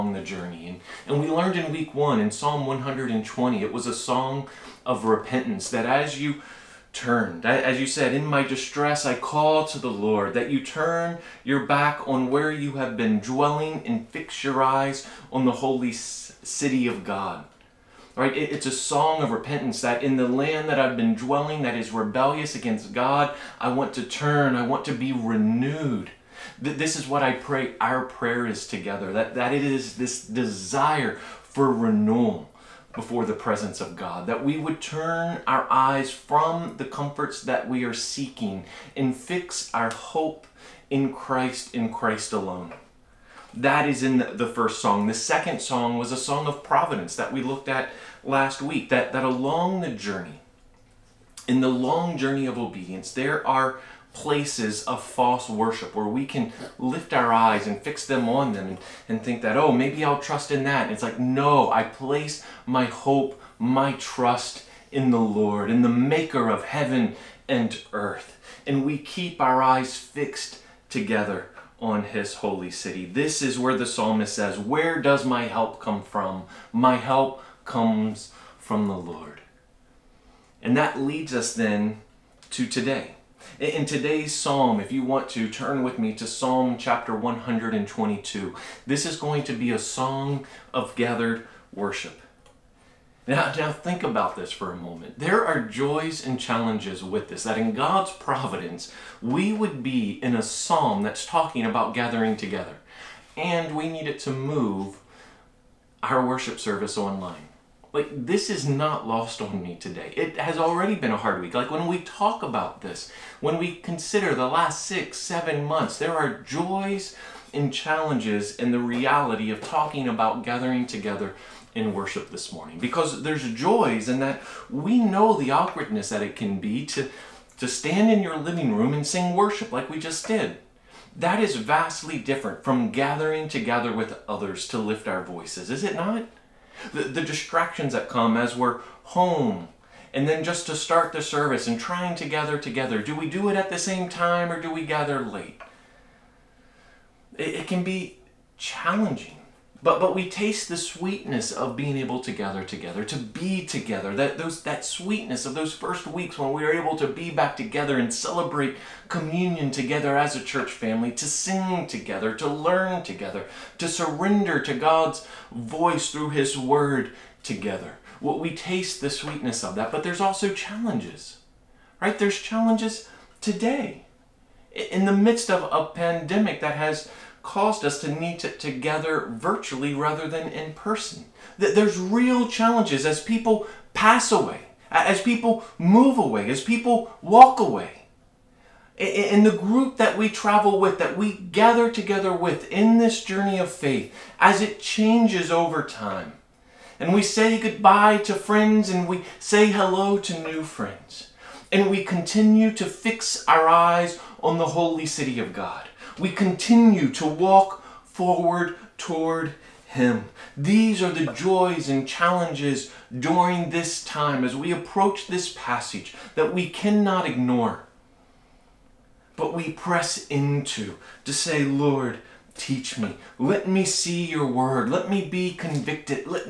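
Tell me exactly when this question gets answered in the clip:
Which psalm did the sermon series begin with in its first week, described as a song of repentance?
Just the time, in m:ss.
0:02.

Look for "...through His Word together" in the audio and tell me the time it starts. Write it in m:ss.
2:46.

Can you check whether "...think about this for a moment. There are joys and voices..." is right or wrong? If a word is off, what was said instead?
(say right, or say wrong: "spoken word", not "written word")
wrong: "challenges", not "voices".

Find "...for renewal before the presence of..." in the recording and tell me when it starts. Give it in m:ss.
0:31.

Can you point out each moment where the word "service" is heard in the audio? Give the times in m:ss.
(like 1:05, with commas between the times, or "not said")
1:46, 2:21.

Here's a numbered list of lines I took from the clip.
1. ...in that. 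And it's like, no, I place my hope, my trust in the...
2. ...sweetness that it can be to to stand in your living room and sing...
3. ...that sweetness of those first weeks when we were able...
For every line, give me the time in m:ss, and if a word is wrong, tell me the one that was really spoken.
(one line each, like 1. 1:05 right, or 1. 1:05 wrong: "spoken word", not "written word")
1. 1:00 right
2. 2:05 wrong: "awkwardness", not "sweetness"
3. 2:34 right.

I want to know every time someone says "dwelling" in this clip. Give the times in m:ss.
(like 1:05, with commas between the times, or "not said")
0:13, 0:21.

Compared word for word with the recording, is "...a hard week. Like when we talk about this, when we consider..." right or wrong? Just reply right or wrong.
right.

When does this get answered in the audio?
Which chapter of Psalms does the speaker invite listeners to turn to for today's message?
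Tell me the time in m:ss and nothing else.
1:27.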